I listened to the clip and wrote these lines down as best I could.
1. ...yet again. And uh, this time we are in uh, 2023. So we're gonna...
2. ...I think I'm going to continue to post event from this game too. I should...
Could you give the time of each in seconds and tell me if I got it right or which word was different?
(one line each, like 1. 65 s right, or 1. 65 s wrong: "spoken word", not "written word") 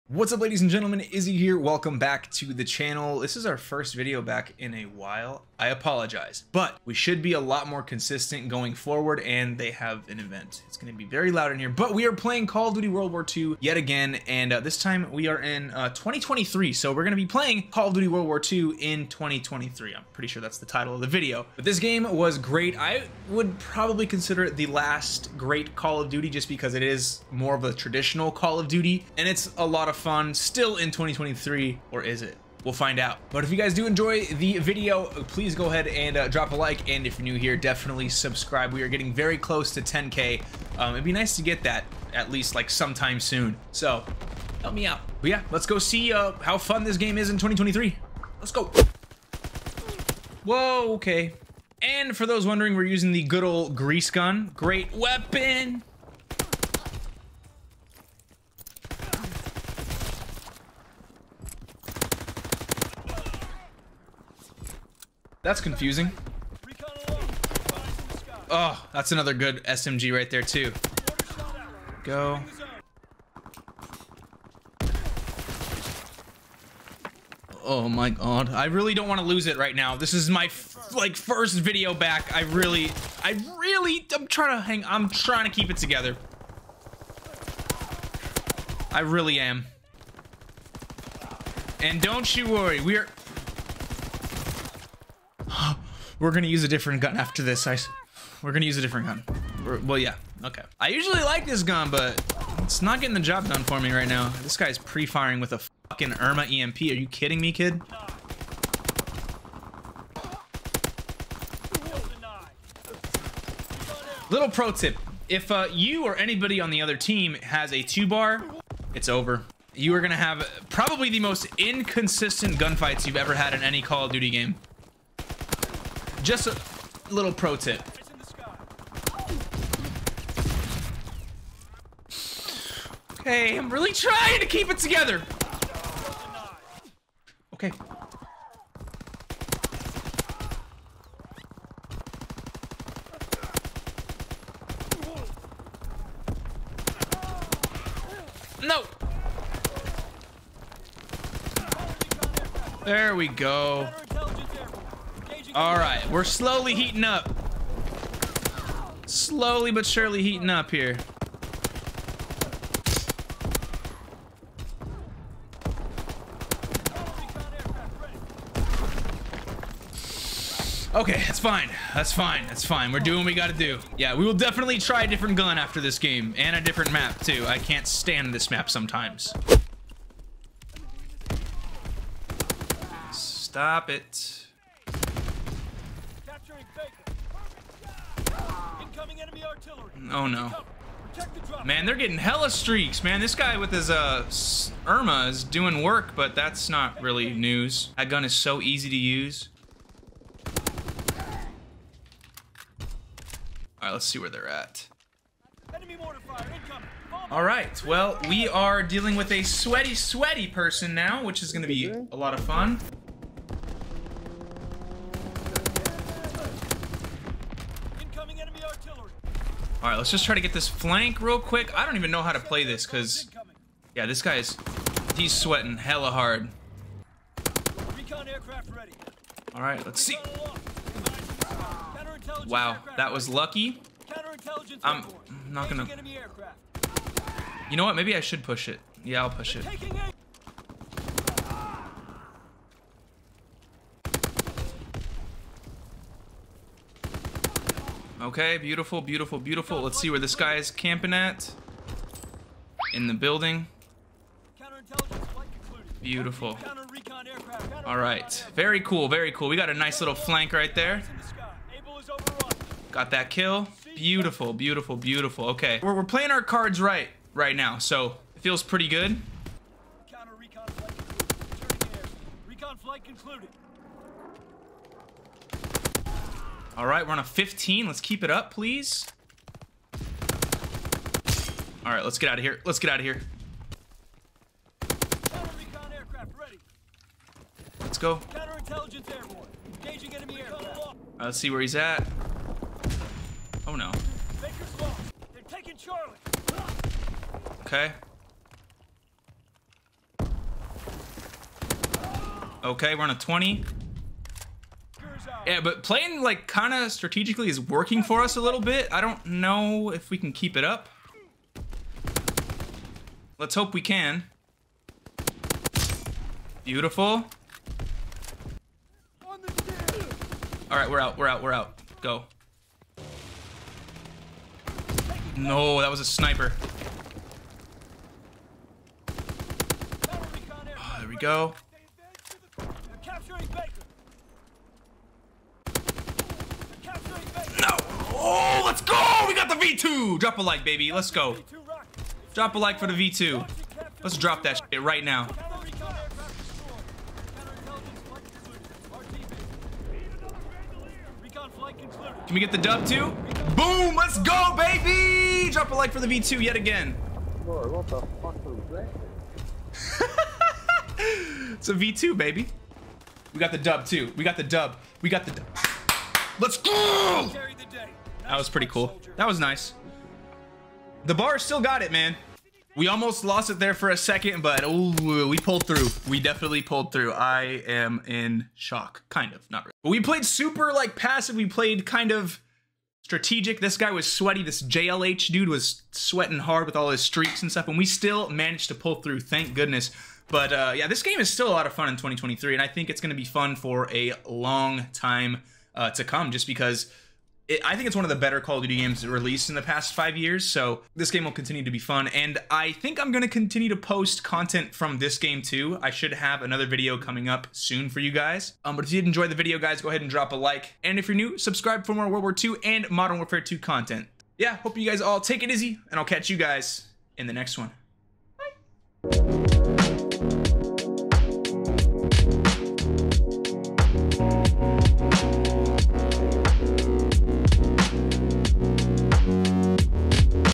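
1. 13 s right
2. 402 s wrong: "content", not "event".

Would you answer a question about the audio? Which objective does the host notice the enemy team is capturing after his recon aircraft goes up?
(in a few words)
Charlie.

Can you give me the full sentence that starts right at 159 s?
Slowly but surely heating up here.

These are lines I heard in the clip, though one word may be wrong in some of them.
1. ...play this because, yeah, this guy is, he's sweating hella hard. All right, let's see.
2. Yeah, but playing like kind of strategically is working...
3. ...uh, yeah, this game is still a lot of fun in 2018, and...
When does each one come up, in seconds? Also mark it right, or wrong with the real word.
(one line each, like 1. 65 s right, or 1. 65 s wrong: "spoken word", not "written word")
1. 222 s right
2. 305 s right
3. 390 s wrong: "2023", not "2018".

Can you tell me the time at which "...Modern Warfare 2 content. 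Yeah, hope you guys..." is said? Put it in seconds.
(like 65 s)
412 s.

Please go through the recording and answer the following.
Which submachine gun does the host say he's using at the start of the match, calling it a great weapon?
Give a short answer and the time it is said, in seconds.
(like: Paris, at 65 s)
grease gun, at 53 s.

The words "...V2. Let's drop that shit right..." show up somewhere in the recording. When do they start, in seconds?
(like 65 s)
342 s.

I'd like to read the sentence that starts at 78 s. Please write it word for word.
I really don't want to lose it right now.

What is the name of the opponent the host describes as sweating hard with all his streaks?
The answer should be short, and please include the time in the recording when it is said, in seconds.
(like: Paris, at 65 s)
JLH, at 384 s.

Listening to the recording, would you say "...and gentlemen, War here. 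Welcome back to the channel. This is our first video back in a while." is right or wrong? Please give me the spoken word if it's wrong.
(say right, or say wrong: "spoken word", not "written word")
wrong: "Izzy", not "War".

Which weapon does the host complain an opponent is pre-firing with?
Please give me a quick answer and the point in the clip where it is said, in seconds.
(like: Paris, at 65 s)
Irma EMP, at 106 s.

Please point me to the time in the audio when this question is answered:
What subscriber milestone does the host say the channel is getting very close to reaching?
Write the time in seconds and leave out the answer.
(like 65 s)
39 s.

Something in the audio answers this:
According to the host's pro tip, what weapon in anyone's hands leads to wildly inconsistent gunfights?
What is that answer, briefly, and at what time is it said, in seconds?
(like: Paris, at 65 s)
two bar, at 117 s.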